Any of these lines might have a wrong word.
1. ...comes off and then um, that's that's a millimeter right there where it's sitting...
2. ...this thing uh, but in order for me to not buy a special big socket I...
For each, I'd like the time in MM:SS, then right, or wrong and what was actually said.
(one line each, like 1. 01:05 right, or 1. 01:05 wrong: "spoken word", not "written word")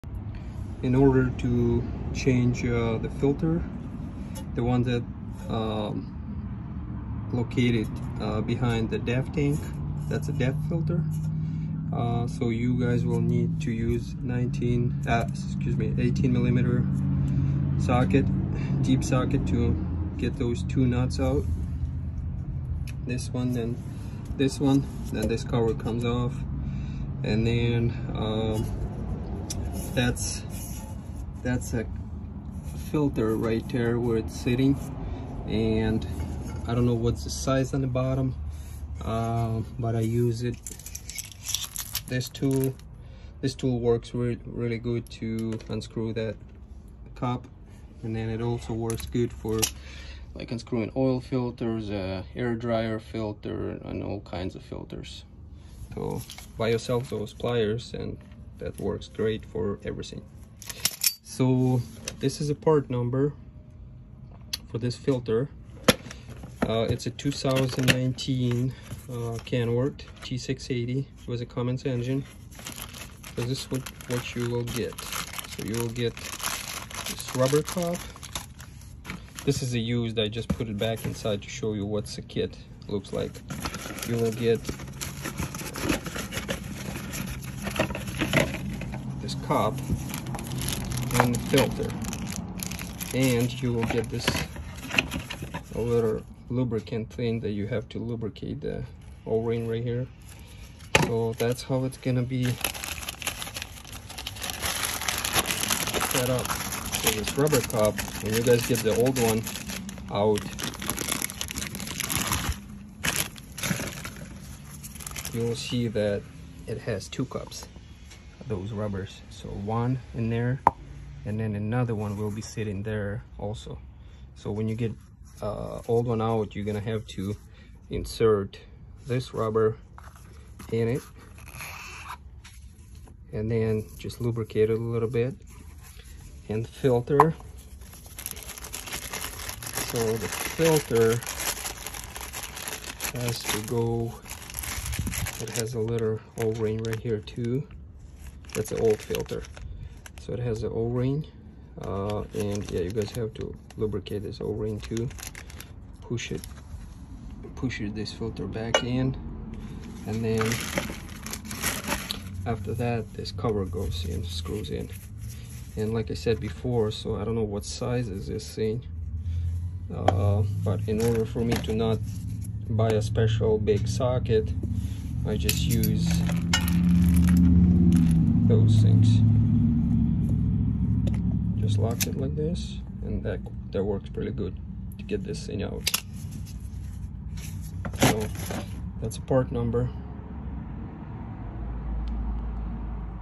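1. 00:25 wrong: "filter", not "millimeter"
2. 02:48 right.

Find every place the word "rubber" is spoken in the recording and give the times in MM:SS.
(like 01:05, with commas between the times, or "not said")
01:17, 01:47, 01:58, 02:09.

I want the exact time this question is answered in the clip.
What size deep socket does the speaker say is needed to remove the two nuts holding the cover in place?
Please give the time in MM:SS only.
00:15.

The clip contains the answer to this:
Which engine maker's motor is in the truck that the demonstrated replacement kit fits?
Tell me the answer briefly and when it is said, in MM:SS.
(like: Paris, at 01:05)
Cummins, at 01:11.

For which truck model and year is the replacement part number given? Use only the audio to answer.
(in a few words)
2019 Kenworth T680.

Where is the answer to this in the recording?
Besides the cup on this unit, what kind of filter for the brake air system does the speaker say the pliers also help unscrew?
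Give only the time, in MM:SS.
00:52.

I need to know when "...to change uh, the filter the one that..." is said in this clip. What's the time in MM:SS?
00:01.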